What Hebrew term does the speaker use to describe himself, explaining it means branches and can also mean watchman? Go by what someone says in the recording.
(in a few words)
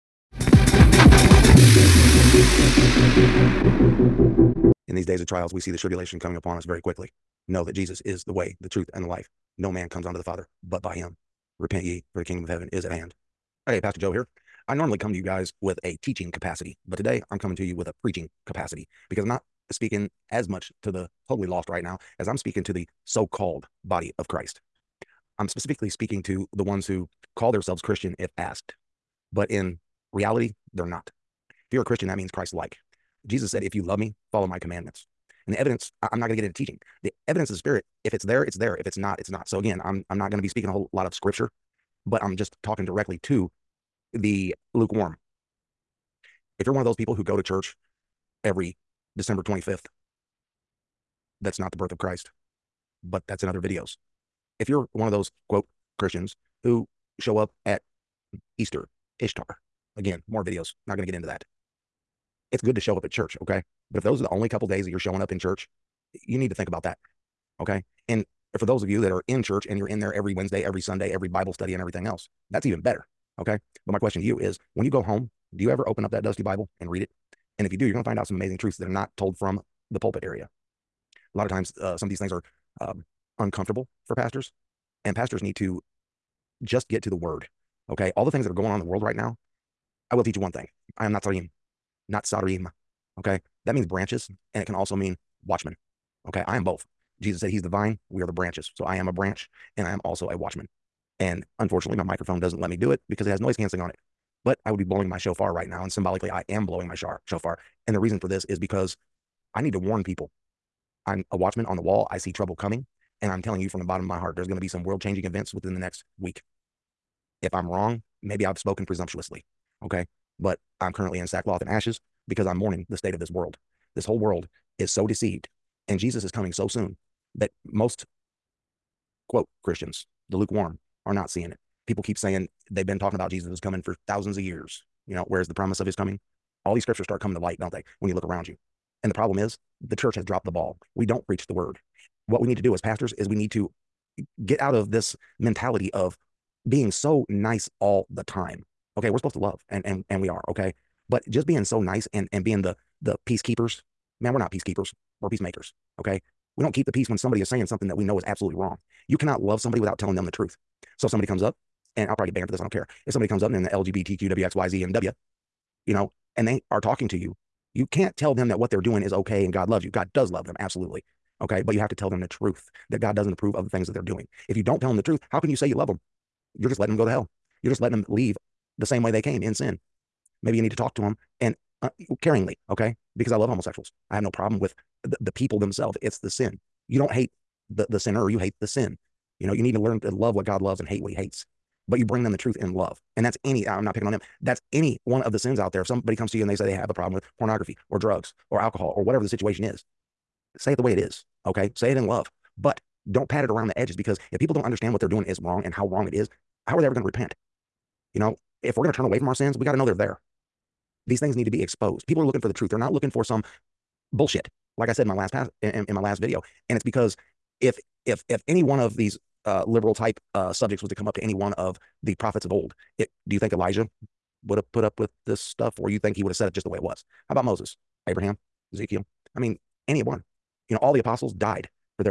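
Netzarim.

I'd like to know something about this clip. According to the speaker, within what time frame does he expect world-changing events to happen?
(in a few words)
Within the next week.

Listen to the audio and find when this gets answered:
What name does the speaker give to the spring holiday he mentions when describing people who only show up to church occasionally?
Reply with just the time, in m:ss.
0:59.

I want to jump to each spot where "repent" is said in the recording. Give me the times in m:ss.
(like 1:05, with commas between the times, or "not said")
0:11, 3:27.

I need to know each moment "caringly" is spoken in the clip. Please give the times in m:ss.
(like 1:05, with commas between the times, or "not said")
3:02.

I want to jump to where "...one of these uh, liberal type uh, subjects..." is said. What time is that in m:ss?
3:38.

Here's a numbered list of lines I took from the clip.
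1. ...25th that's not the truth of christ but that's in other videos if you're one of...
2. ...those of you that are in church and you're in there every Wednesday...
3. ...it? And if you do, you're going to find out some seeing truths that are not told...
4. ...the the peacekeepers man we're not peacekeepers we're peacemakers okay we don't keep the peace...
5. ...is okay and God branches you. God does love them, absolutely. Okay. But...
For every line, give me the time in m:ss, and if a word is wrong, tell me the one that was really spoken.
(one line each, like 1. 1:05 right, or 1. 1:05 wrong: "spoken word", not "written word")
1. 0:49 wrong: "birth", not "truth"
2. 1:08 right
3. 1:17 wrong: "amazing", not "seeing"
4. 2:32 right
5. 2:49 wrong: "loves", not "branches".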